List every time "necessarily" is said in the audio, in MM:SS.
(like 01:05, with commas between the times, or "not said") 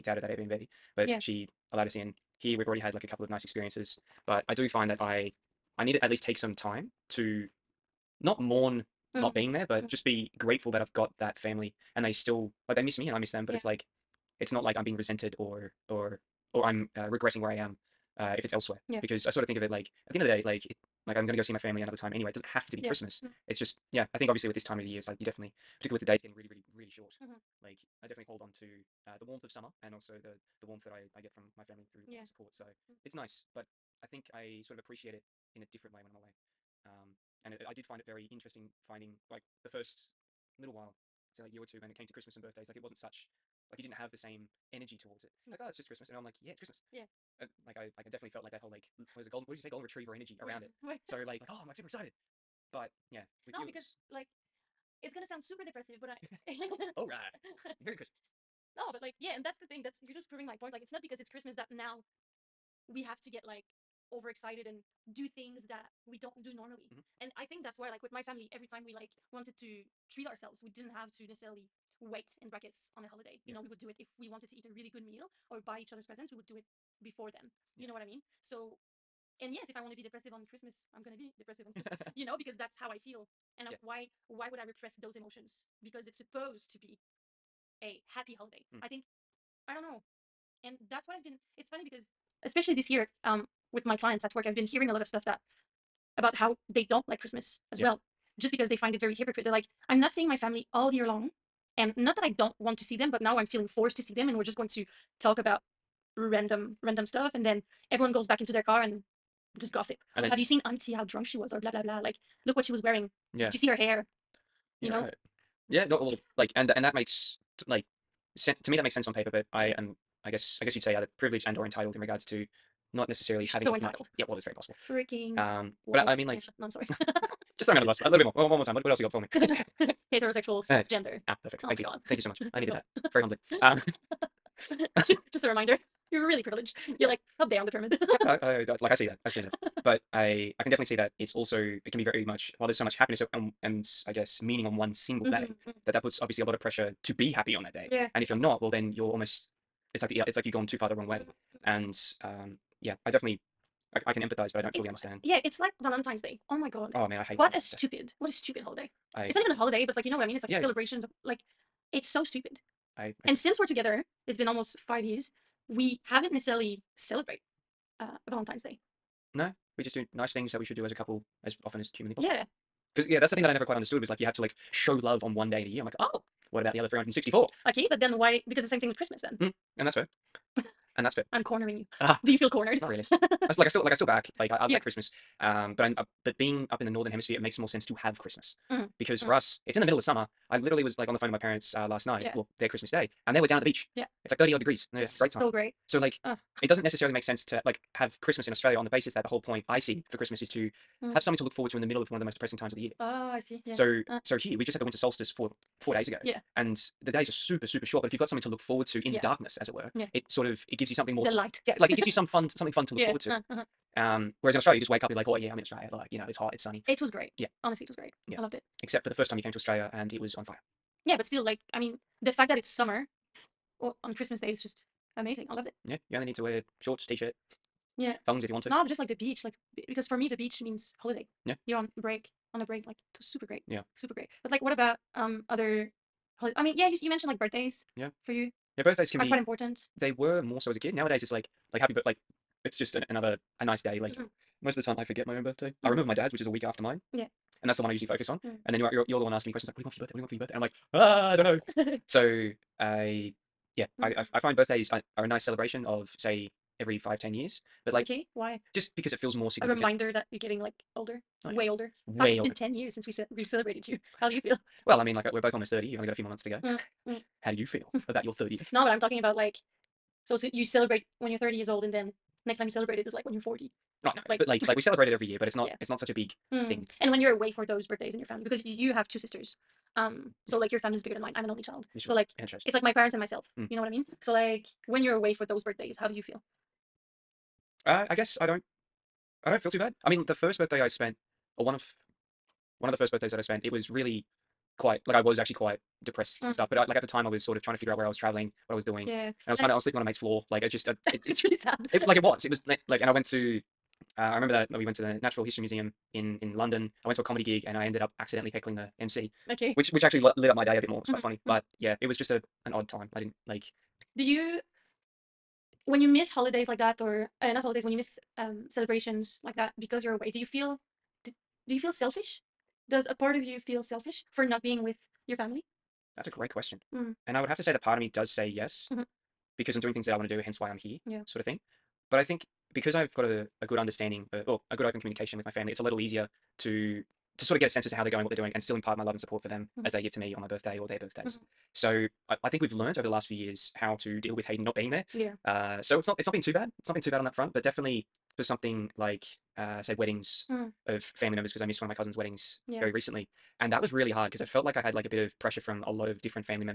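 01:11, 02:03, 02:46, 03:16.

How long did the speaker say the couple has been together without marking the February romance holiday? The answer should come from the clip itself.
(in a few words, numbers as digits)
Almost 5 years.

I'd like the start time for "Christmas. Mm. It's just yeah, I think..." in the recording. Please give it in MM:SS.
00:22.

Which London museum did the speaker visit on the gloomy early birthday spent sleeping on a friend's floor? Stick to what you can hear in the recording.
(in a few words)
Natural History Museum.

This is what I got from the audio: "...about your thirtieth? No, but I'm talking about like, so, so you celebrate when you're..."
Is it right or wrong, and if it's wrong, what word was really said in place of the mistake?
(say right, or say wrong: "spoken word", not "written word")
right.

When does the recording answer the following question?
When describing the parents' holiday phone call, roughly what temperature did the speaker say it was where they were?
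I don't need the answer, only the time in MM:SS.
03:14.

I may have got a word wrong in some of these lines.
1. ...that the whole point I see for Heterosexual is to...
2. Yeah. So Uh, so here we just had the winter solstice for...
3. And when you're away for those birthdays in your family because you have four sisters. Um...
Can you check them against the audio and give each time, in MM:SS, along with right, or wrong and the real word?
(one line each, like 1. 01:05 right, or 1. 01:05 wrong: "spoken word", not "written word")
1. 03:19 wrong: "Christmas", not "Heterosexual"
2. 03:23 right
3. 04:36 wrong: "two", not "four".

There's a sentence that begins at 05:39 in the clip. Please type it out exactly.
as they give to me on my birthday or their birthdays.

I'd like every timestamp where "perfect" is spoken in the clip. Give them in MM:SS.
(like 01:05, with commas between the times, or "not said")
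02:11.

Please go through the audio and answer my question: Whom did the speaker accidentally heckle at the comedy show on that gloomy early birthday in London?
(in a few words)
The MC.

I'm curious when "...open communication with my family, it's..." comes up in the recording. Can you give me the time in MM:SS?
05:34.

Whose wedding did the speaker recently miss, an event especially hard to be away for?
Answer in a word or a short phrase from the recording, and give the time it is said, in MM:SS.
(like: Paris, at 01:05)
Cousin, at 05:51.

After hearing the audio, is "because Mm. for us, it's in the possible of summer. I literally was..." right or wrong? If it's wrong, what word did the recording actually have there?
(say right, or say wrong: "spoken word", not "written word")
wrong: "middle", not "possible".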